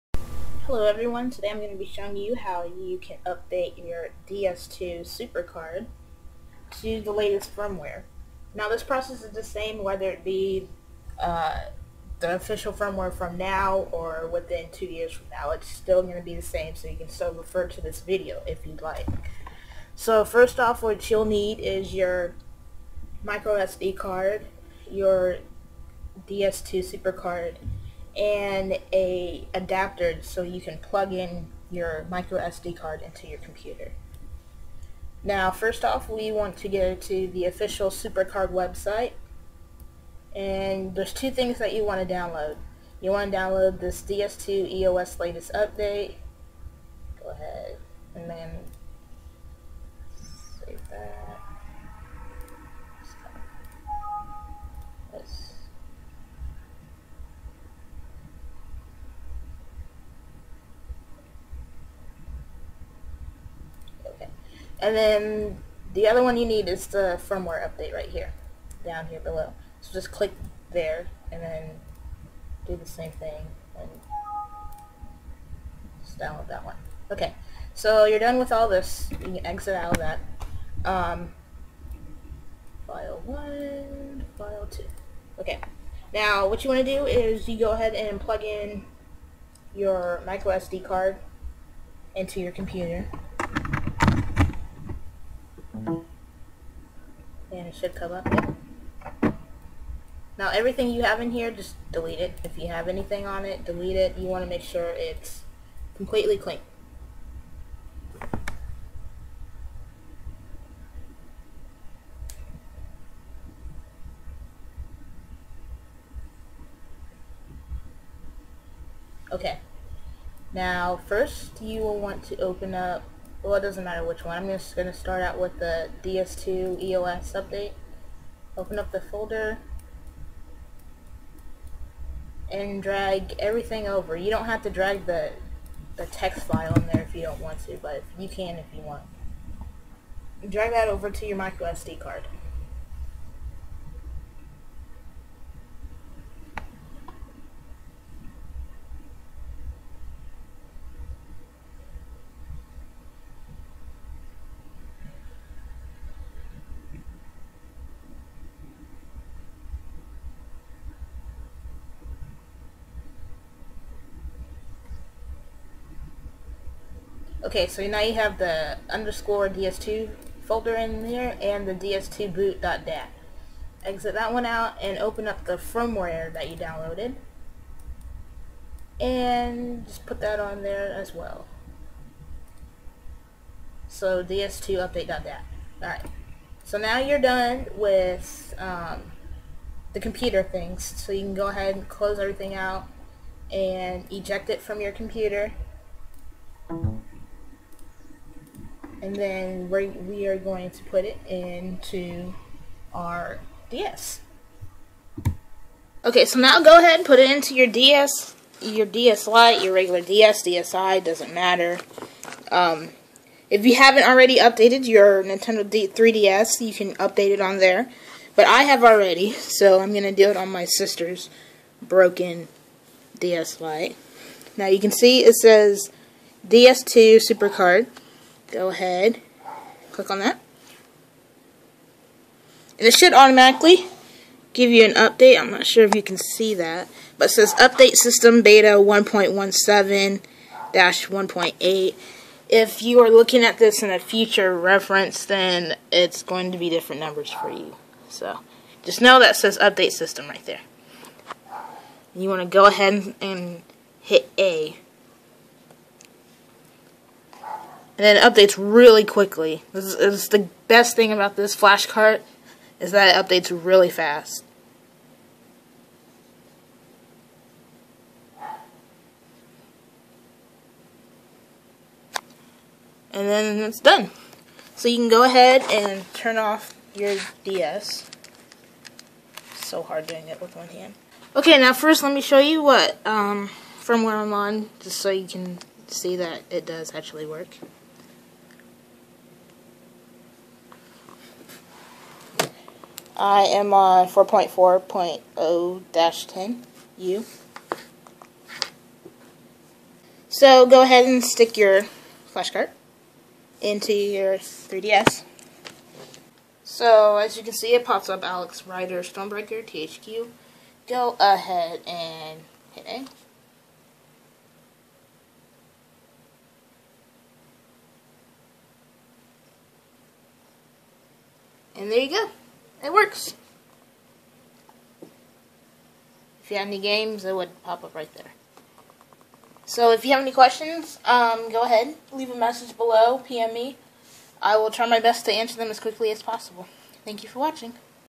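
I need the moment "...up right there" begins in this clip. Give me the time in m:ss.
5:27.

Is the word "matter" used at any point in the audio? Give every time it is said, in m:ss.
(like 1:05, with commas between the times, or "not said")
2:03, 3:31.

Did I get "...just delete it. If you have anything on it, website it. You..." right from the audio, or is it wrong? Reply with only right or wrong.
wrong.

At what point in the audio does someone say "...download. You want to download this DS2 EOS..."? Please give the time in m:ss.
0:42.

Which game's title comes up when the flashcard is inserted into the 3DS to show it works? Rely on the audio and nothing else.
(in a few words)
Alex Rider Stormbreaker.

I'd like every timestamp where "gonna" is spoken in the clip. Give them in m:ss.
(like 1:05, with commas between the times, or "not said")
2:04.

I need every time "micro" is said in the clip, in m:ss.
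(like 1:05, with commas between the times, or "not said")
0:23, 0:32, 1:30, 2:21.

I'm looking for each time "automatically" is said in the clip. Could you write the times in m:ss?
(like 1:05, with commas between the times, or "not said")
3:53.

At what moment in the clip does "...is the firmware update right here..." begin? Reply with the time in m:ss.
1:06.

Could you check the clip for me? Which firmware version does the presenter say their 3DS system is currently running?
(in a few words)
4.4.0-10 U.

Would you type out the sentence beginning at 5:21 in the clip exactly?
And there you go it works.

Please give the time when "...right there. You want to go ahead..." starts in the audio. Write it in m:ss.
4:10.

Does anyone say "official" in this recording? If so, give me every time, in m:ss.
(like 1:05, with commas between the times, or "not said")
0:12, 0:37.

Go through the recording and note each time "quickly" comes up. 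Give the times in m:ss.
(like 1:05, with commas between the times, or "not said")
4:19, 5:35.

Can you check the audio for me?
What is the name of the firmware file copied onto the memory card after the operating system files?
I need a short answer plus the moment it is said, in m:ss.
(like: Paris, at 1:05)
ds2 update.dat, at 3:04.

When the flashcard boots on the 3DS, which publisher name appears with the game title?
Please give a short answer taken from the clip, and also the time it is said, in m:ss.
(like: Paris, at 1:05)
THQ, at 5:09.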